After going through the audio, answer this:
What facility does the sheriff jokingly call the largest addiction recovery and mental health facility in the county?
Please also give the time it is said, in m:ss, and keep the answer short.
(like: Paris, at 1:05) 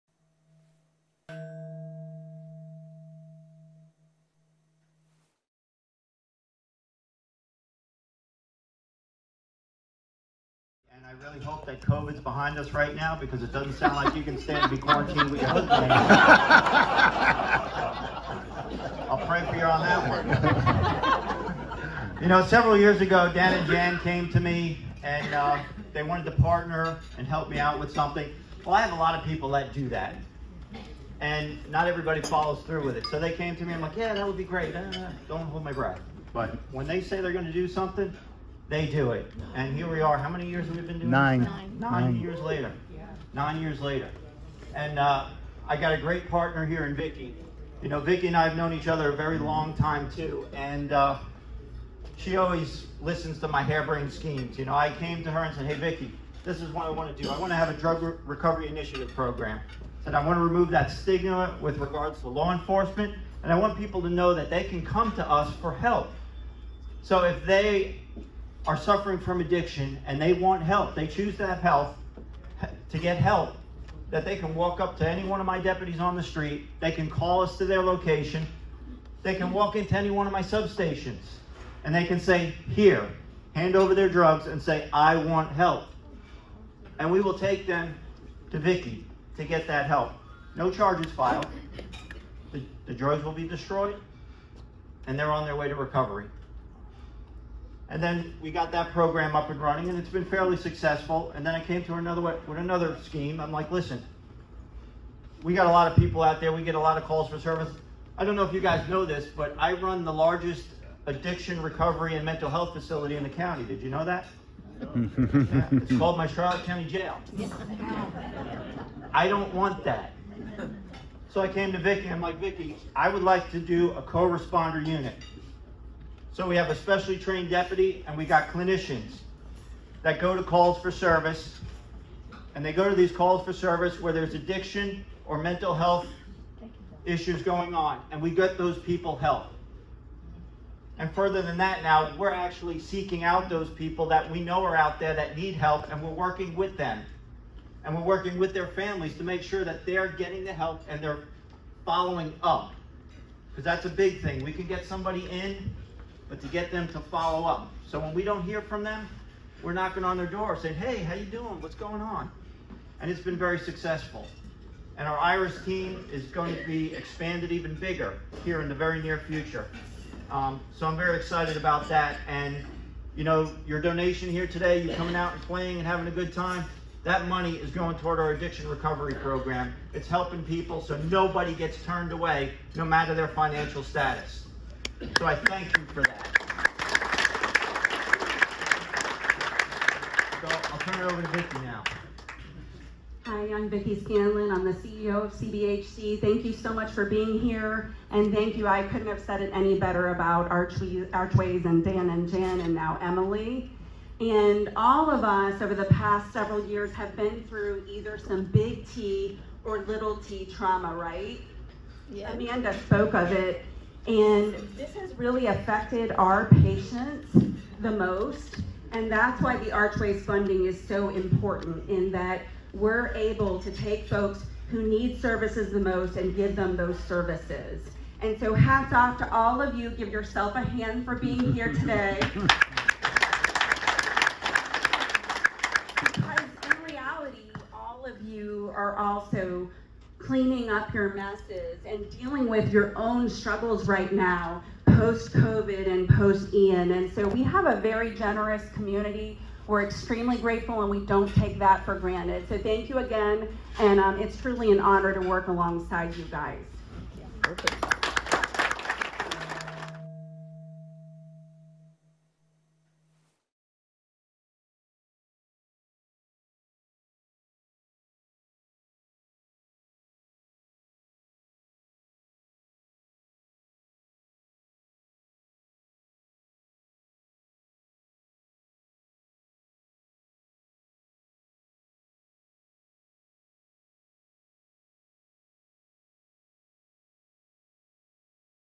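Charlotte County Jail, at 1:56.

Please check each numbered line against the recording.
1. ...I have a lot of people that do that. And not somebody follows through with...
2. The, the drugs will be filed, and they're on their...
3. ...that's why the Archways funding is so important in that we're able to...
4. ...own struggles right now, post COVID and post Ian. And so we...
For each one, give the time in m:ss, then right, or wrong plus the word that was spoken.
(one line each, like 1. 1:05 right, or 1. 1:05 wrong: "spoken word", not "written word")
1. 0:28 wrong: "everybody", not "somebody"
2. 1:32 wrong: "destroyed", not "filed"
3. 3:39 right
4. 4:02 right.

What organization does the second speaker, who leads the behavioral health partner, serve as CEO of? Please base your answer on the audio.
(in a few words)
CBHC.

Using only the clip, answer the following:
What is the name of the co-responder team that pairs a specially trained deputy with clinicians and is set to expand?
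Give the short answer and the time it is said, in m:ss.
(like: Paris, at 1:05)
IRIS, at 2:45.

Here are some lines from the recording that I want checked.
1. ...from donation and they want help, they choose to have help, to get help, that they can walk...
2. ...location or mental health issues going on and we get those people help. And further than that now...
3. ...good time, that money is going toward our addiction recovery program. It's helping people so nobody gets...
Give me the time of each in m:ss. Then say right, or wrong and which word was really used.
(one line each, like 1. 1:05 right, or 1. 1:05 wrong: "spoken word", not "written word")
1. 1:09 wrong: "addiction", not "donation"
2. 2:14 wrong: "addiction", not "location"
3. 2:56 right.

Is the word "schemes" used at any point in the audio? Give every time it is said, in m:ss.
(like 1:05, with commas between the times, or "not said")
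0:54, 1:43.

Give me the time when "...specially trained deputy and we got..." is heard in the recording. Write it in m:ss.
2:06.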